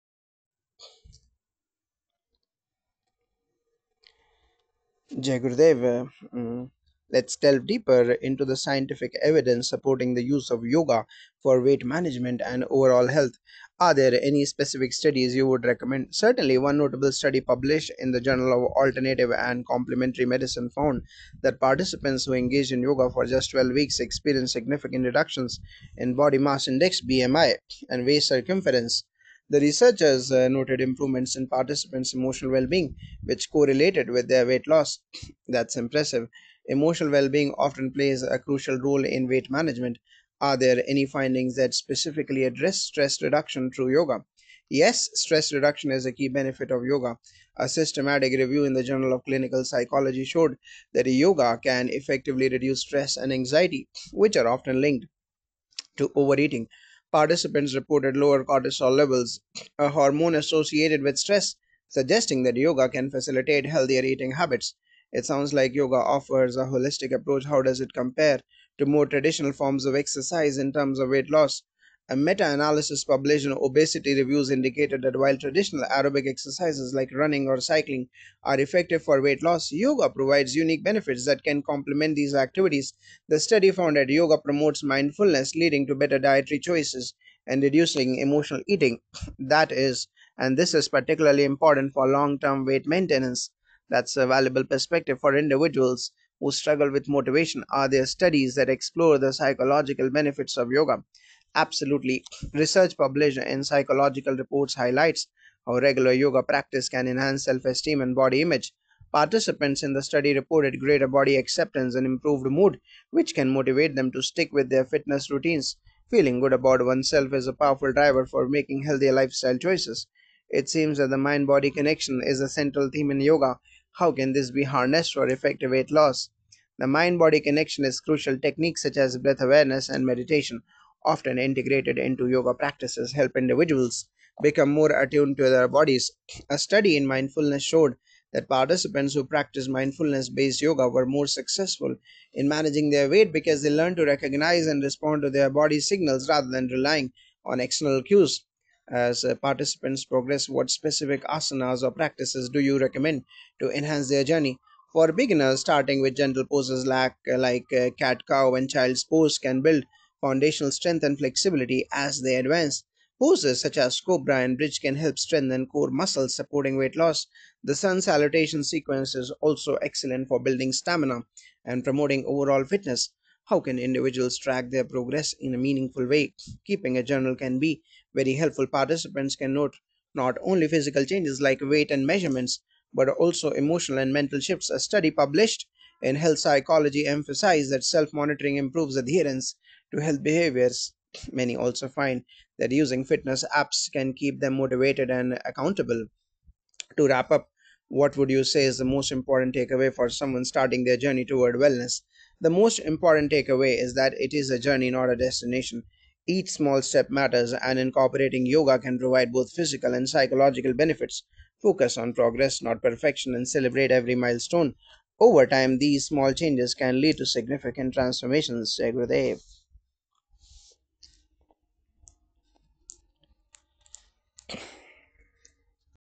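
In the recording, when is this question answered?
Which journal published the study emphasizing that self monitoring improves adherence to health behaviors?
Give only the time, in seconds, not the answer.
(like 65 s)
186 s.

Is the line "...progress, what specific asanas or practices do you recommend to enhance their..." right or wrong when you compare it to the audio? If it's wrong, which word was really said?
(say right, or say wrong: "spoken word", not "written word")
right.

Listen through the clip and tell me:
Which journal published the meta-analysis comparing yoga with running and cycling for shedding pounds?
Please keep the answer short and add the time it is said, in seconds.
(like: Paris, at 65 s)
Obesity Reviews, at 73 s.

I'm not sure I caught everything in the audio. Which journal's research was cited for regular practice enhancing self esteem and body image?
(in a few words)
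Psychological Reports.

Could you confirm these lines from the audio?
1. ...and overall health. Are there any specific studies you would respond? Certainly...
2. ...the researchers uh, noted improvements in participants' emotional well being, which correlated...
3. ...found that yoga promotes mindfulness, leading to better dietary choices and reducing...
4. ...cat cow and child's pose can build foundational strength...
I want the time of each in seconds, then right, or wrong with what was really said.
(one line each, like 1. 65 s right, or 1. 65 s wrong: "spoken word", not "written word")
1. 12 s wrong: "recommend", not "respond"
2. 29 s right
3. 83 s right
4. 157 s right.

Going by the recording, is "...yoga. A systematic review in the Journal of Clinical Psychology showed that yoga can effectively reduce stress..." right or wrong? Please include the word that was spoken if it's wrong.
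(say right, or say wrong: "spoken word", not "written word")
right.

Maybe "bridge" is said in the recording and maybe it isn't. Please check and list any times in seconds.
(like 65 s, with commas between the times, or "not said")
164 s.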